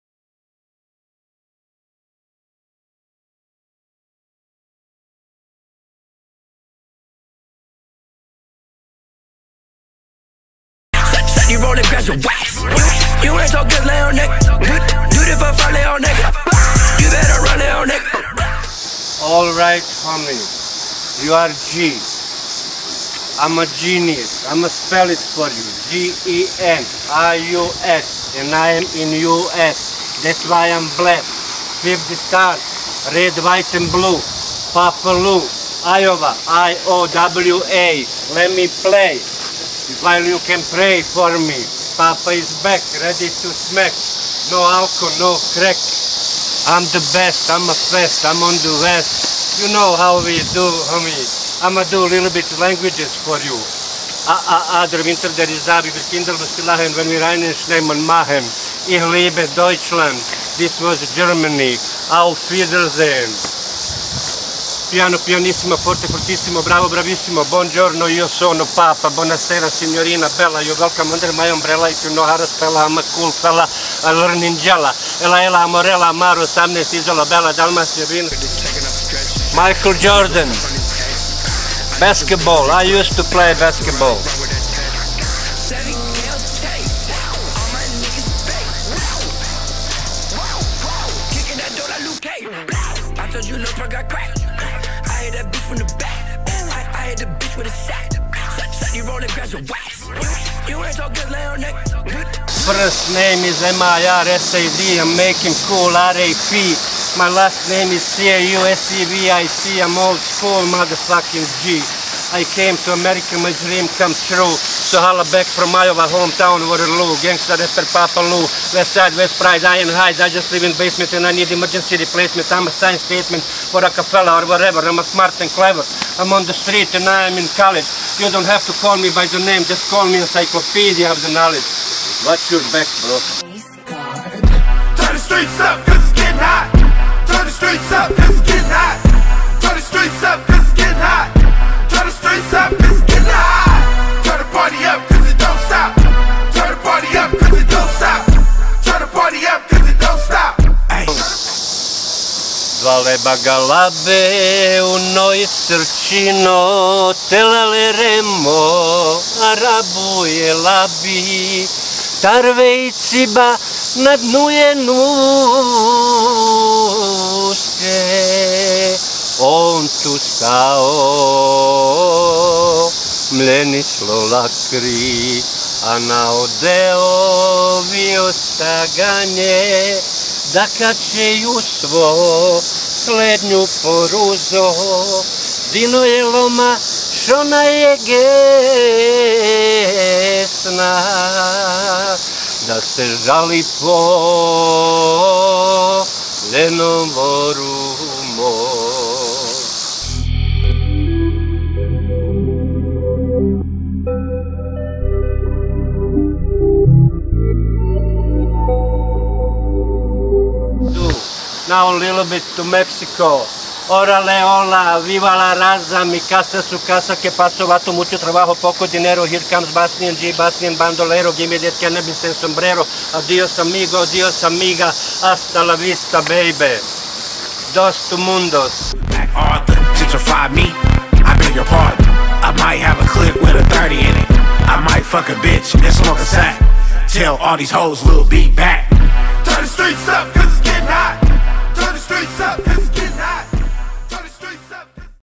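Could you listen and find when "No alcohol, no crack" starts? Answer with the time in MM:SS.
00:44.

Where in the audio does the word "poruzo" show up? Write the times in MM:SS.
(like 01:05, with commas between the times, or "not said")
03:03.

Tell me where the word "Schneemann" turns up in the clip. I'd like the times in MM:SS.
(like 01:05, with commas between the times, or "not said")
00:57.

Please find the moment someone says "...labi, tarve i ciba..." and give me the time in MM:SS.
02:40.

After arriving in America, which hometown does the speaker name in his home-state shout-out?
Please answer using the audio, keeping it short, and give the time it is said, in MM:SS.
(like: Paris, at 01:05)
Waterloo, at 01:56.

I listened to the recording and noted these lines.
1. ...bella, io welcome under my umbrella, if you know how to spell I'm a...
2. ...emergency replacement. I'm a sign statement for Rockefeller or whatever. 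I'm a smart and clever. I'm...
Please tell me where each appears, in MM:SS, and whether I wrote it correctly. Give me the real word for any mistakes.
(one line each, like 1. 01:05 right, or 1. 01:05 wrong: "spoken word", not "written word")
1. 01:10 right
2. 02:01 right.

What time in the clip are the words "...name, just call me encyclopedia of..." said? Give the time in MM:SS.
02:09.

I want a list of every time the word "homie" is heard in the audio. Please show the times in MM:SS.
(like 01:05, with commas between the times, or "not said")
00:20, 00:50.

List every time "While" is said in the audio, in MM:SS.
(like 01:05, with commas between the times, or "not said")
00:40.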